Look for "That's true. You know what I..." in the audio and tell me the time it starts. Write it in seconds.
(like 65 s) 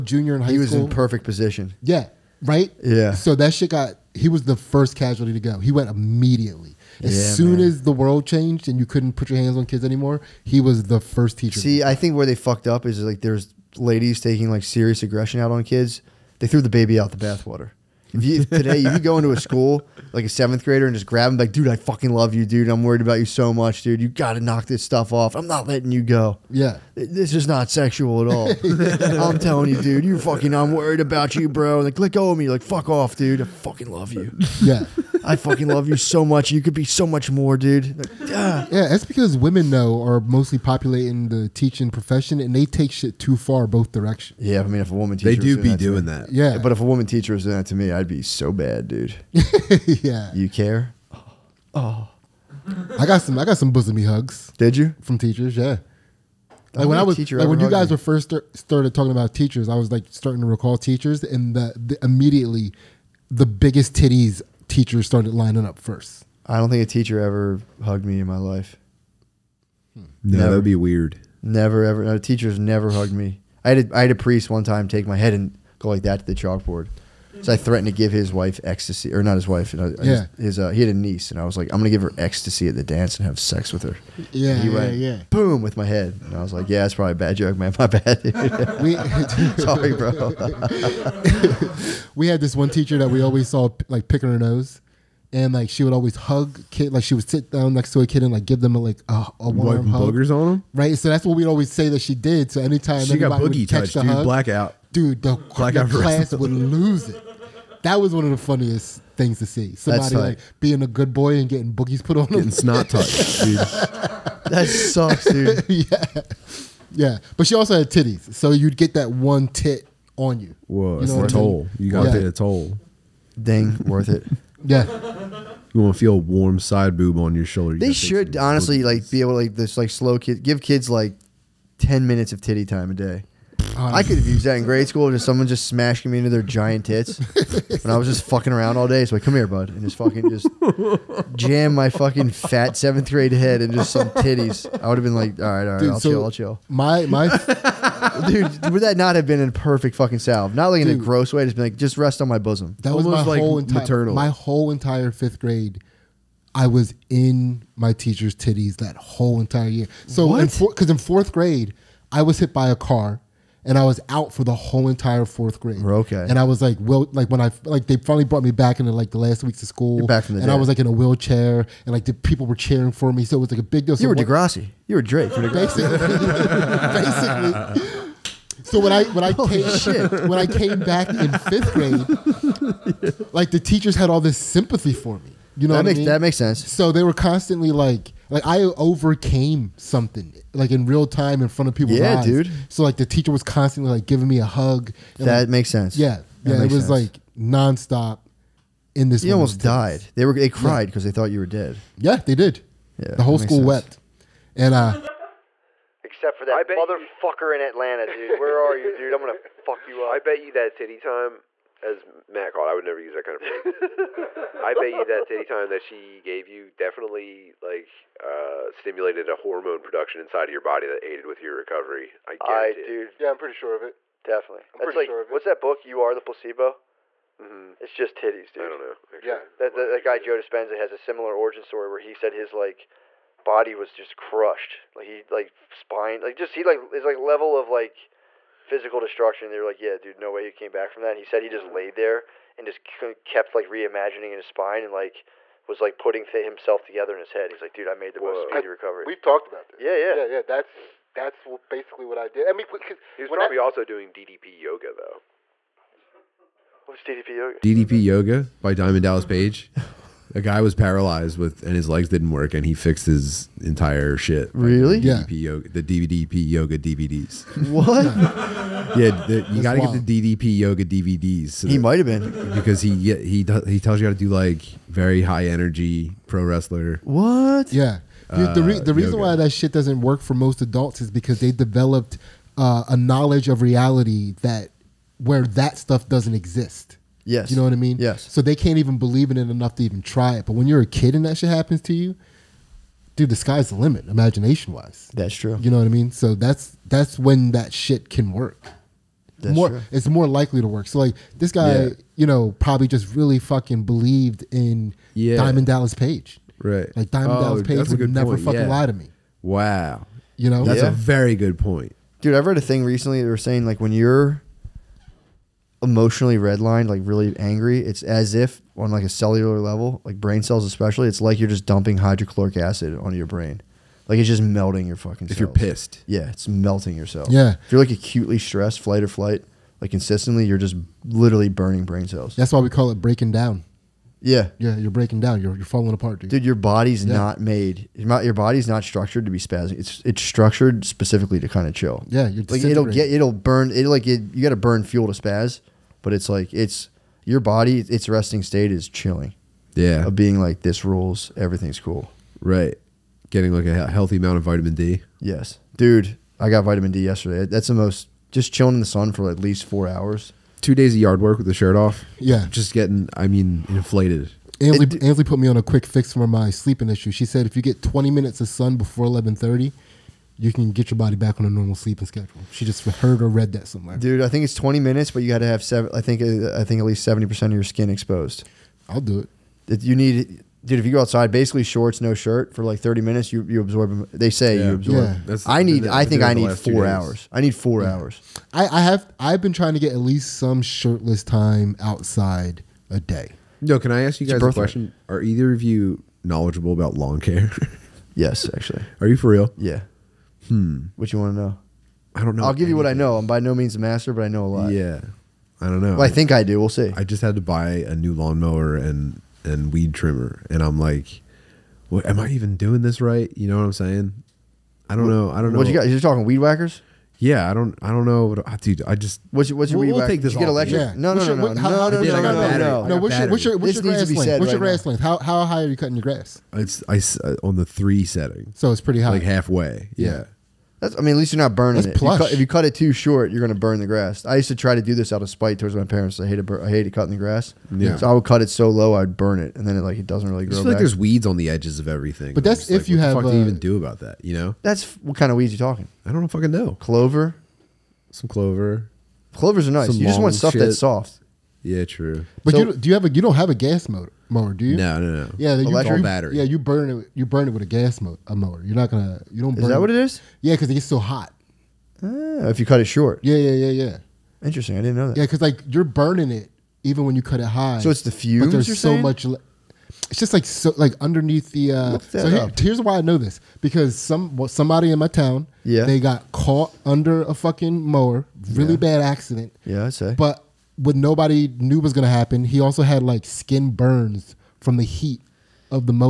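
295 s.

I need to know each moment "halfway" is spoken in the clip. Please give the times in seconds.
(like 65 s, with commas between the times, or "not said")
429 s.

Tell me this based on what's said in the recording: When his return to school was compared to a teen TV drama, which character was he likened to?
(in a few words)
Drake.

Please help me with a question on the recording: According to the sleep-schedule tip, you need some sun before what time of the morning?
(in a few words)
11:30.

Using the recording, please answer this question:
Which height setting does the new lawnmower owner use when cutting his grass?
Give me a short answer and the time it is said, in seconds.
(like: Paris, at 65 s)
3, at 427 s.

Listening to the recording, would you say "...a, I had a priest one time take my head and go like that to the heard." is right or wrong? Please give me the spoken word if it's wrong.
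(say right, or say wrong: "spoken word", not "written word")
wrong: "chalkboard", not "heard".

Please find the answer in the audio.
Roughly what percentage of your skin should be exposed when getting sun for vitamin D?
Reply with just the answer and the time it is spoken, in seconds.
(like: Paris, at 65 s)
70 percent, at 377 s.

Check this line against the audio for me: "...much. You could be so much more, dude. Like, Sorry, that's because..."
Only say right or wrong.
wrong.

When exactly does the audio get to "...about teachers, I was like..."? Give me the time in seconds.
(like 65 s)
59 s.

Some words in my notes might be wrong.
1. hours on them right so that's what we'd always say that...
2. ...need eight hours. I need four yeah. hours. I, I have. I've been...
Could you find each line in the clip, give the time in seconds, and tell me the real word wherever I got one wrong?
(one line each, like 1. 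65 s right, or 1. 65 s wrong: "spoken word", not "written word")
1. 99 s wrong: "boogers", not "hours"
2. 386 s wrong: "four", not "eight".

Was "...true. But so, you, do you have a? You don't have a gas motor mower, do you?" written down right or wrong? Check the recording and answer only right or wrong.
right.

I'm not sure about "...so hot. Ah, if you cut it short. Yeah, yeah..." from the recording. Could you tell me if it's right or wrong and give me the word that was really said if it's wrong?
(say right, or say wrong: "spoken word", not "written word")
right.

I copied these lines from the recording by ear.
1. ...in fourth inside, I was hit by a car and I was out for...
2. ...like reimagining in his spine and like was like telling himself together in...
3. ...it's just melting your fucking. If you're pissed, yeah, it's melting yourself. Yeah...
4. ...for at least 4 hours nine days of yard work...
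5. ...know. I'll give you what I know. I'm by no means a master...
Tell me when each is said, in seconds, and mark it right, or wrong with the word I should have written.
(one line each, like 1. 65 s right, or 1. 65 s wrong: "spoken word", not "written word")
1. 160 s wrong: "grade", not "inside"
2. 243 s wrong: "putting", not "telling"
3. 324 s right
4. 359 s wrong: "two", not "nine"
5. 402 s right.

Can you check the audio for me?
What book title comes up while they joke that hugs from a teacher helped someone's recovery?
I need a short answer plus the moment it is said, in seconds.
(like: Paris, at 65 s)
You Are the Placebo, at 225 s.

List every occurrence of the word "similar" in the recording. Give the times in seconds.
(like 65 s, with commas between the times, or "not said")
230 s.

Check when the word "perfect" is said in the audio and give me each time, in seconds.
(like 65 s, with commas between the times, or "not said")
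0 s, 149 s.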